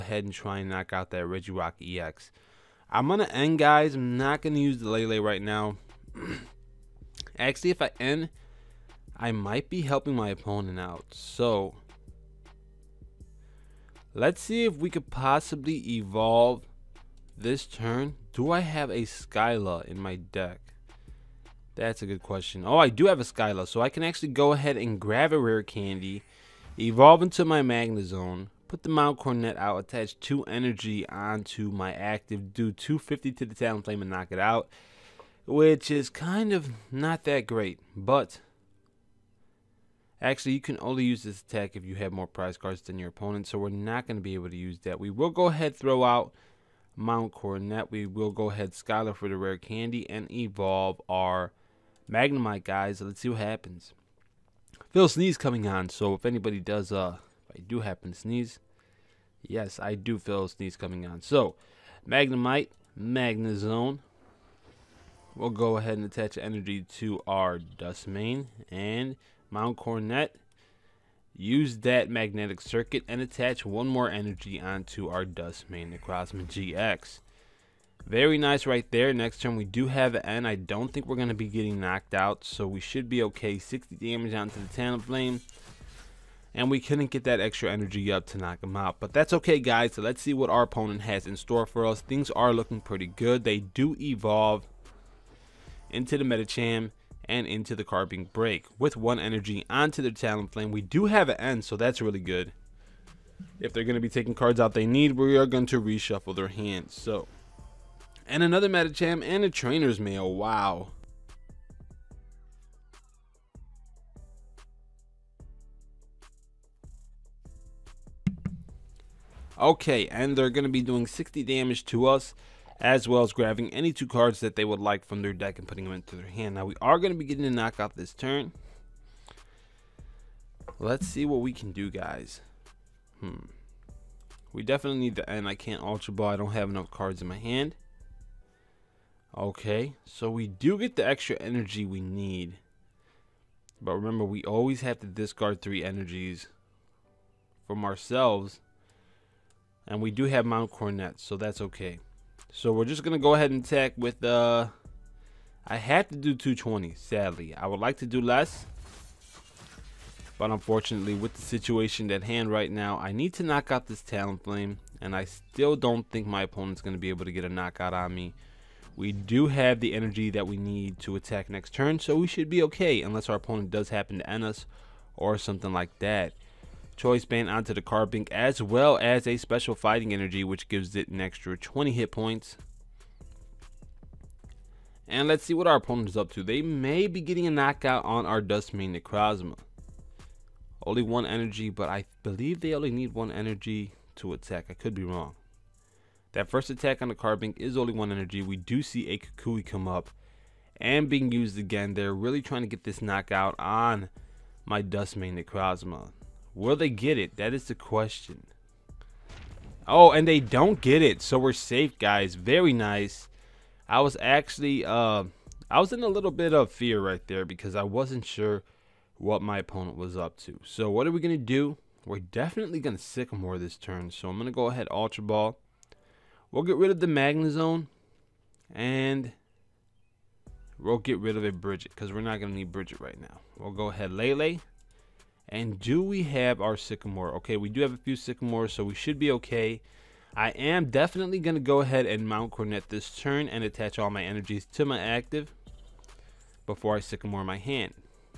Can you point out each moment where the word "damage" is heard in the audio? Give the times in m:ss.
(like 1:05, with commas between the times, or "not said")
1:23, 2:01.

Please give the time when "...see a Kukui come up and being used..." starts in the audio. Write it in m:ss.
3:18.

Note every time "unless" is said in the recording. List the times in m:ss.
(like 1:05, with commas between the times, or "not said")
2:53.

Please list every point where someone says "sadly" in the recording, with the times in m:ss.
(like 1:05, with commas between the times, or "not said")
2:36.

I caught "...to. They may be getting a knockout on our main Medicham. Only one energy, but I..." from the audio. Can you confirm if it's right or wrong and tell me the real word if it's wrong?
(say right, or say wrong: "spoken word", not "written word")
wrong: "Necrozma", not "Medicham".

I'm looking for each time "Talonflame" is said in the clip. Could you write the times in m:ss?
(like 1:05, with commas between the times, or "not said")
1:24, 1:40, 2:44.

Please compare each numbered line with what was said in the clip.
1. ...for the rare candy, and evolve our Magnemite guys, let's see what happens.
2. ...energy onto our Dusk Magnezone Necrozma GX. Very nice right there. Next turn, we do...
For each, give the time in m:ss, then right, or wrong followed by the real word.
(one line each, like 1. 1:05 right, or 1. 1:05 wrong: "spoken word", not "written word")
1. 0:49 right
2. 1:14 wrong: "Mane", not "Magnezone".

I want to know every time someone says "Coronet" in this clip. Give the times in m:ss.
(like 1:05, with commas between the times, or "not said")
0:29, 0:47, 1:09, 2:30, 4:02.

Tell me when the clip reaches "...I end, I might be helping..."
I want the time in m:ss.
0:07.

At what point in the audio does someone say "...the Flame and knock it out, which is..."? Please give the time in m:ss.
0:33.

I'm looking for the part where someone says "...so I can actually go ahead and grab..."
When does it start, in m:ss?
0:23.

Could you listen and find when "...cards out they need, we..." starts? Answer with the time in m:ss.
1:44.